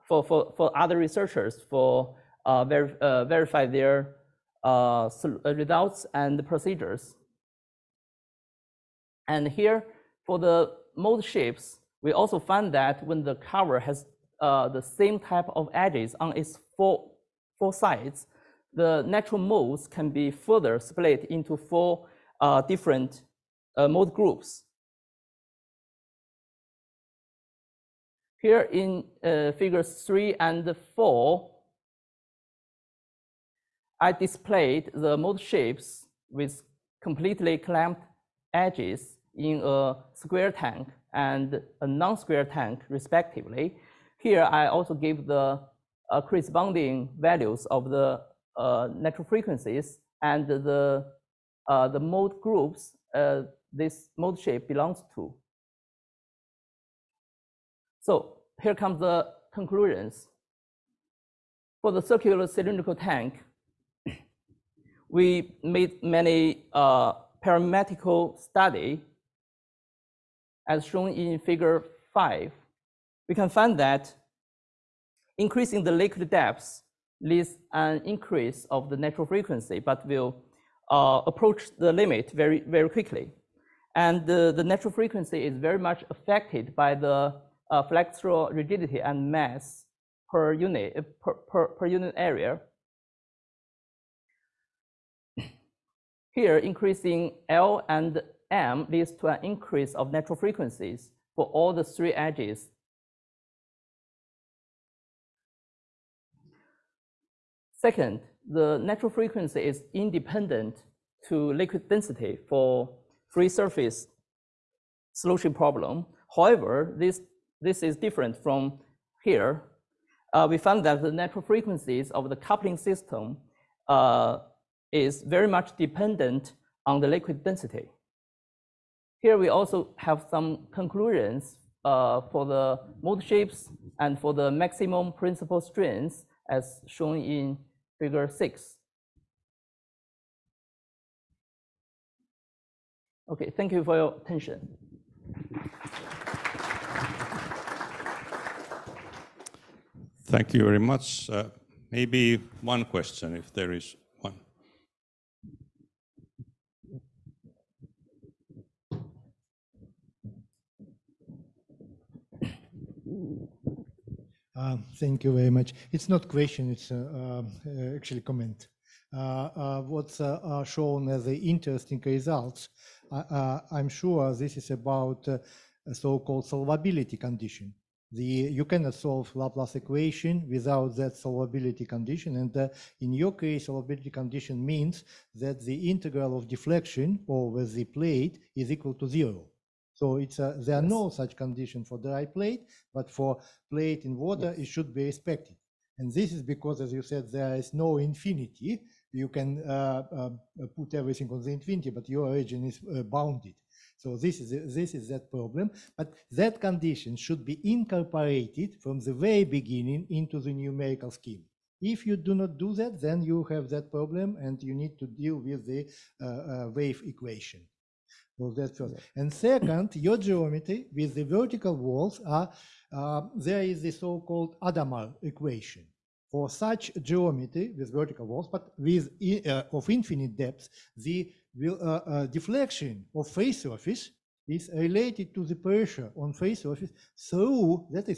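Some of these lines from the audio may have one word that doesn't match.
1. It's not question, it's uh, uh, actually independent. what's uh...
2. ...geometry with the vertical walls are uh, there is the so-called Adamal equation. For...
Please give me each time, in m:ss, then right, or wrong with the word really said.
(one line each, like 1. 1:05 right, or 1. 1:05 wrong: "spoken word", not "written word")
1. 2:45 wrong: "comment", not "independent"
2. 3:40 right.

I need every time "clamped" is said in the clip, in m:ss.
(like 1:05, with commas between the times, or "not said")
0:37.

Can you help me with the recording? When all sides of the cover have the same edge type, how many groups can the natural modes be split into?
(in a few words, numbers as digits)
4.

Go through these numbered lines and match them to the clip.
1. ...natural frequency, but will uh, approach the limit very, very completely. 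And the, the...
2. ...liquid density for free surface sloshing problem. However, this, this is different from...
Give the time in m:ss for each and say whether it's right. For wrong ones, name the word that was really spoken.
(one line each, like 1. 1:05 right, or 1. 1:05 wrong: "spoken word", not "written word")
1. 1:18 wrong: "quickly", not "completely"
2. 1:51 right.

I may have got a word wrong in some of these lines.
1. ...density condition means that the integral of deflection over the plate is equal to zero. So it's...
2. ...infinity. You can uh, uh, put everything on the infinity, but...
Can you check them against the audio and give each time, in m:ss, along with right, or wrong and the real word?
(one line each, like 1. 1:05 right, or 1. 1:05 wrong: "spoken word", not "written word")
1. 3:03 wrong: "solvability", not "density"
2. 3:17 right.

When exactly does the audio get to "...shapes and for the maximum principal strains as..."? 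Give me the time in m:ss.
2:13.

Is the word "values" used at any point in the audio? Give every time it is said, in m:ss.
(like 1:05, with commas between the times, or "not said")
0:47.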